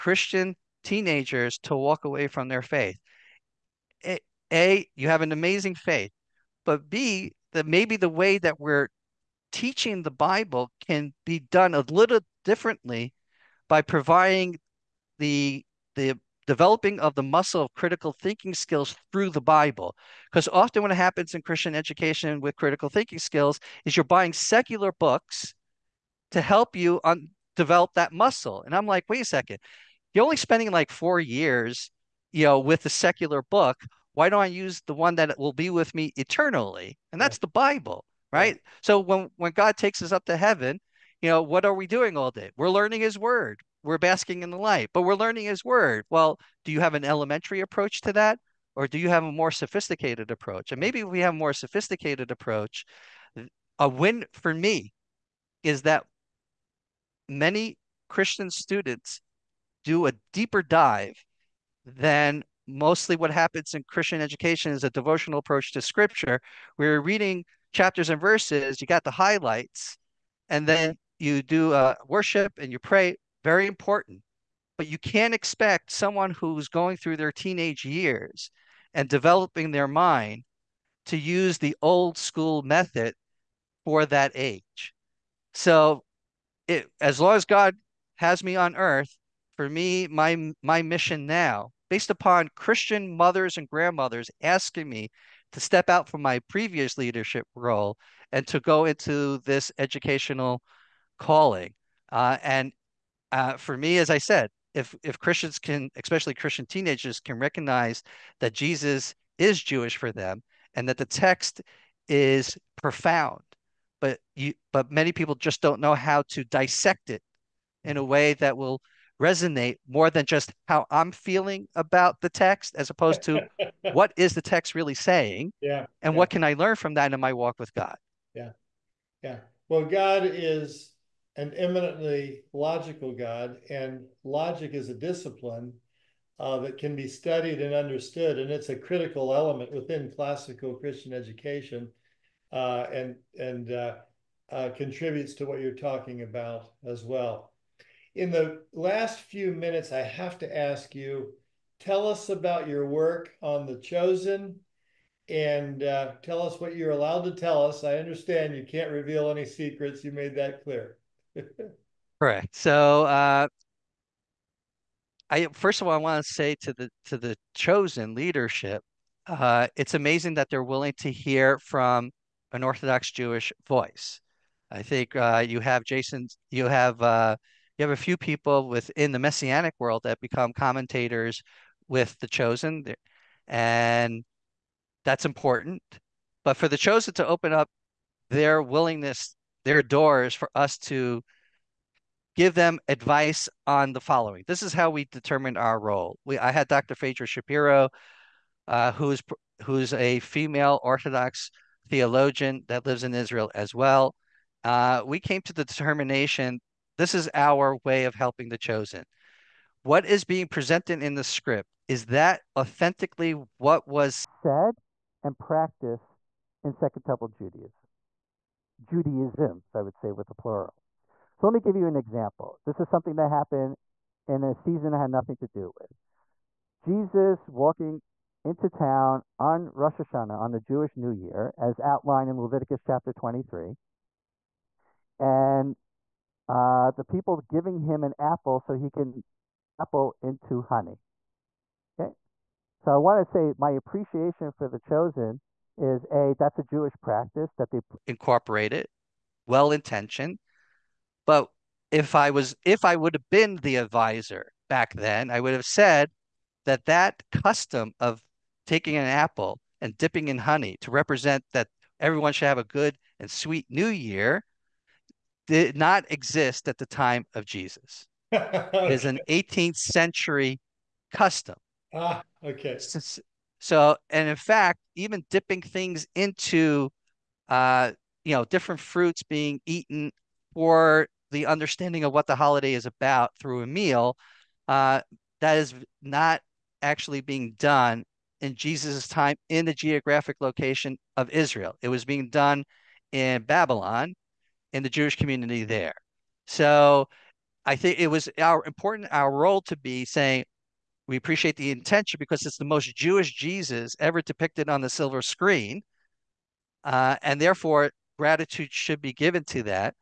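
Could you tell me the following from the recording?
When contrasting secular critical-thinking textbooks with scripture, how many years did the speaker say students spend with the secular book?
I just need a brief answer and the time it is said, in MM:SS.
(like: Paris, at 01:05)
4, at 00:30.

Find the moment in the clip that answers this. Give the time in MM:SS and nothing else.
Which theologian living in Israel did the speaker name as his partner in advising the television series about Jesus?
03:16.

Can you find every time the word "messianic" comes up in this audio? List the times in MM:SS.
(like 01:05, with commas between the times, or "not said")
02:59.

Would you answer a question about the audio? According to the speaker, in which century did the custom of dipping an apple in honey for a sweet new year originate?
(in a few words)
18th century.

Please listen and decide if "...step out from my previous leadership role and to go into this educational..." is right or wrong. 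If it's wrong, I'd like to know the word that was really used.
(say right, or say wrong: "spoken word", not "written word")
right.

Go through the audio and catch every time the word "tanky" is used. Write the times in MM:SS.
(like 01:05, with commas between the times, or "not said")
not said.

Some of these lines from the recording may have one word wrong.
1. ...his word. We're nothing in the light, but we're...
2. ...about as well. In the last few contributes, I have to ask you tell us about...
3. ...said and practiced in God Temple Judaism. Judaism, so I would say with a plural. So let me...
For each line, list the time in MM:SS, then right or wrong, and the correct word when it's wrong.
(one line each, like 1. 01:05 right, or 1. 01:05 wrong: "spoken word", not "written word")
1. 00:43 wrong: "basking", not "nothing"
2. 02:26 wrong: "minutes", not "contributes"
3. 03:34 wrong: "Second", not "God".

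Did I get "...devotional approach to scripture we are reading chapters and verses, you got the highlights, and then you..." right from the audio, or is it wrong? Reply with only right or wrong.
right.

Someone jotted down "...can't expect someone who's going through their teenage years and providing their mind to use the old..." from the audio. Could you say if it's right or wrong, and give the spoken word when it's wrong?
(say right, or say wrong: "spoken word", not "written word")
wrong: "developing", not "providing".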